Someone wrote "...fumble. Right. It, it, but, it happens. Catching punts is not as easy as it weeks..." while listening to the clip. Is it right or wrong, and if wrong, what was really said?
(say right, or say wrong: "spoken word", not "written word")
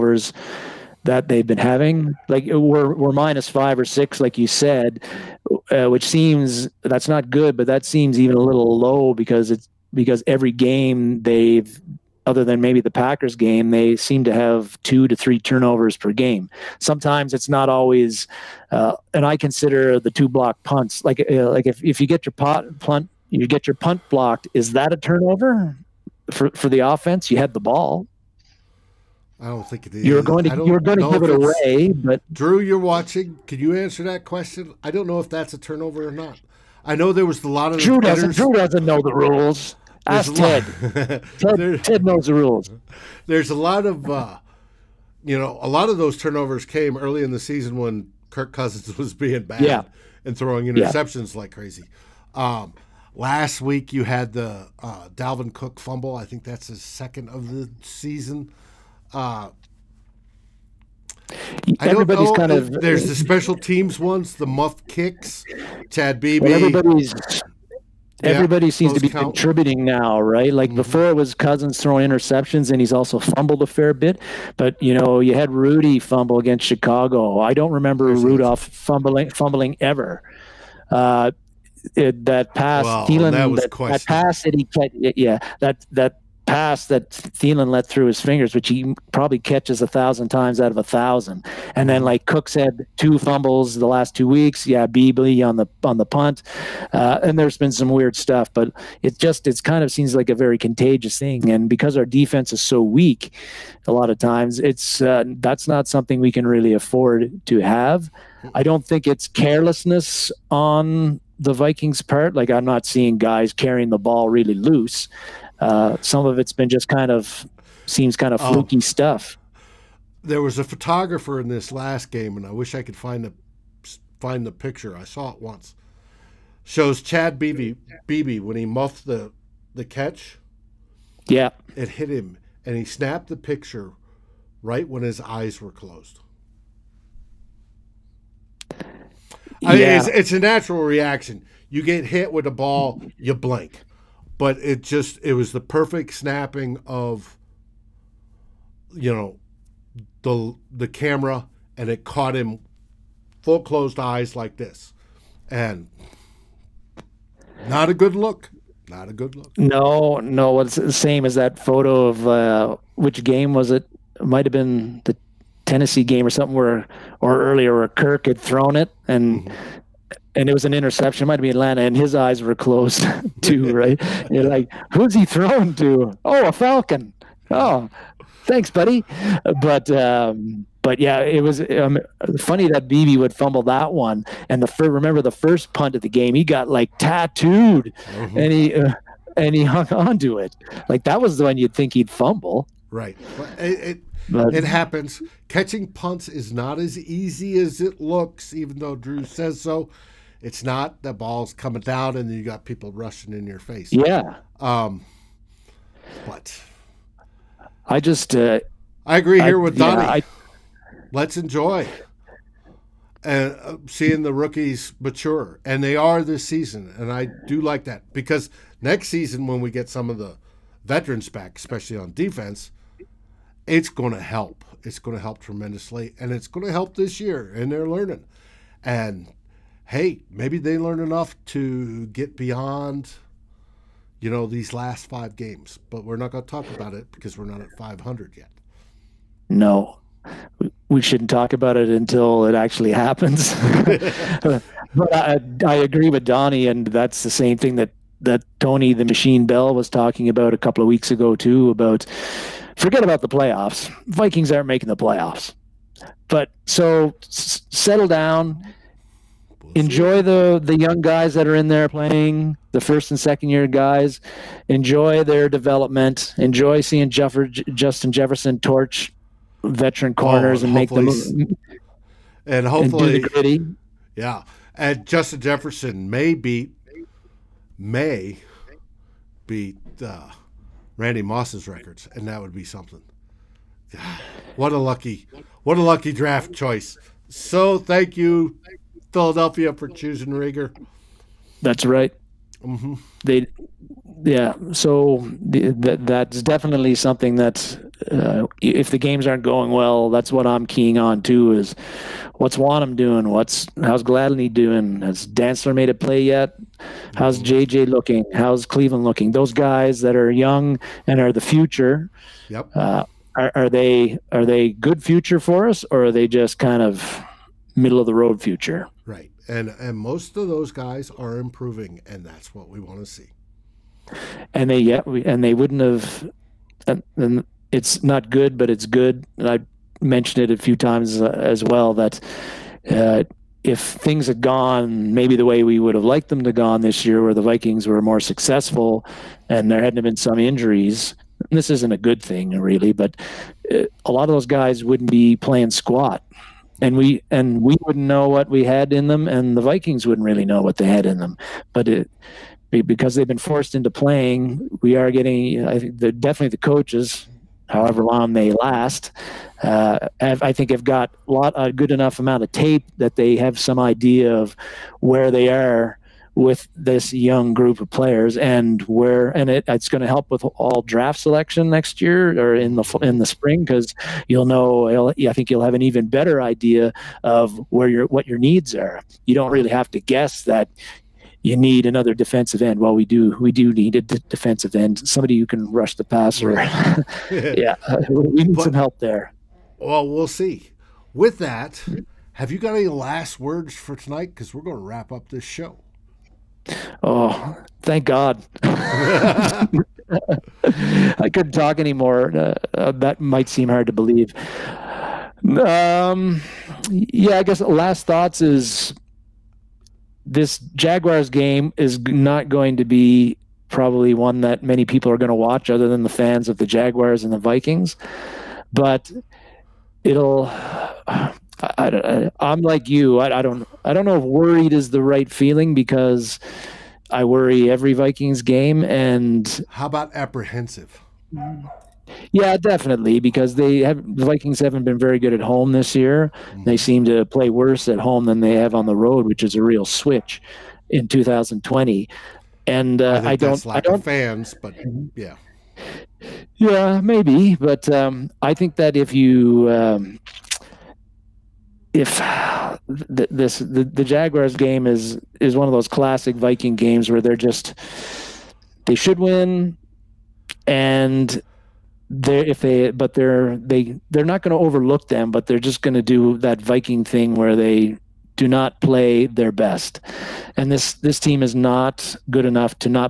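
wrong: "looks", not "weeks".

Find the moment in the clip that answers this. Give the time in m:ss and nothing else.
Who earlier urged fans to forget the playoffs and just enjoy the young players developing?
4:08.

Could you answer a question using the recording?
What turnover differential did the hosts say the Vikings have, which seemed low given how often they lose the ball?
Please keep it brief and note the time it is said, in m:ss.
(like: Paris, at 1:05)
minus 5 or 6, at 0:03.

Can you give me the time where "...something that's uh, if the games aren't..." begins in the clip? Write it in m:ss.
4:56.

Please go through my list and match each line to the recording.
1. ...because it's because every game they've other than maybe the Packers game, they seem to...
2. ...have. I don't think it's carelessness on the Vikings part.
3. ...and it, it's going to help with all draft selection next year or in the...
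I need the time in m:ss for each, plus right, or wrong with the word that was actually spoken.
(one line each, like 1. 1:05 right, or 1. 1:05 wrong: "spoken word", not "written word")
1. 0:09 right
2. 1:47 right
3. 6:09 right.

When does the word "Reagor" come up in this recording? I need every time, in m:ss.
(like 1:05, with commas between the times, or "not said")
4:50.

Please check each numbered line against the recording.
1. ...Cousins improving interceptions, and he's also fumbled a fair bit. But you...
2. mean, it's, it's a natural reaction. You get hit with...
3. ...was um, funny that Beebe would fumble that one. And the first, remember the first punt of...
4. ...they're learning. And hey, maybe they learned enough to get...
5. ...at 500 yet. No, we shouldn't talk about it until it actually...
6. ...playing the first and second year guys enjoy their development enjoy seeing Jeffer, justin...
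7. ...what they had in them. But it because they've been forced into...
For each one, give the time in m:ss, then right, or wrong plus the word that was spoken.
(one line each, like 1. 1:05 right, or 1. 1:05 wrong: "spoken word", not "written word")
1. 1:11 wrong: "throwing", not "improving"
2. 2:19 right
3. 3:01 right
4. 3:47 right
5. 3:57 right
6. 4:21 right
7. 5:50 right.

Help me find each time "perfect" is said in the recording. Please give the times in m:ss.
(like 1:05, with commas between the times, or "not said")
2:25.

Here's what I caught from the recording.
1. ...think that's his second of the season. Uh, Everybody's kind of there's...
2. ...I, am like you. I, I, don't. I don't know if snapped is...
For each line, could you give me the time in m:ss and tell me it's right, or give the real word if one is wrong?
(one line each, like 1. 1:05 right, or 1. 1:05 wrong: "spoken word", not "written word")
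1. 0:56 right
2. 7:01 wrong: "worried", not "snapped".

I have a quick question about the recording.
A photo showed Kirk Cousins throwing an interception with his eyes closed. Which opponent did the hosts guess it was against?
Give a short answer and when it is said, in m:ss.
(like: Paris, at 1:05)
Atlanta, at 2:51.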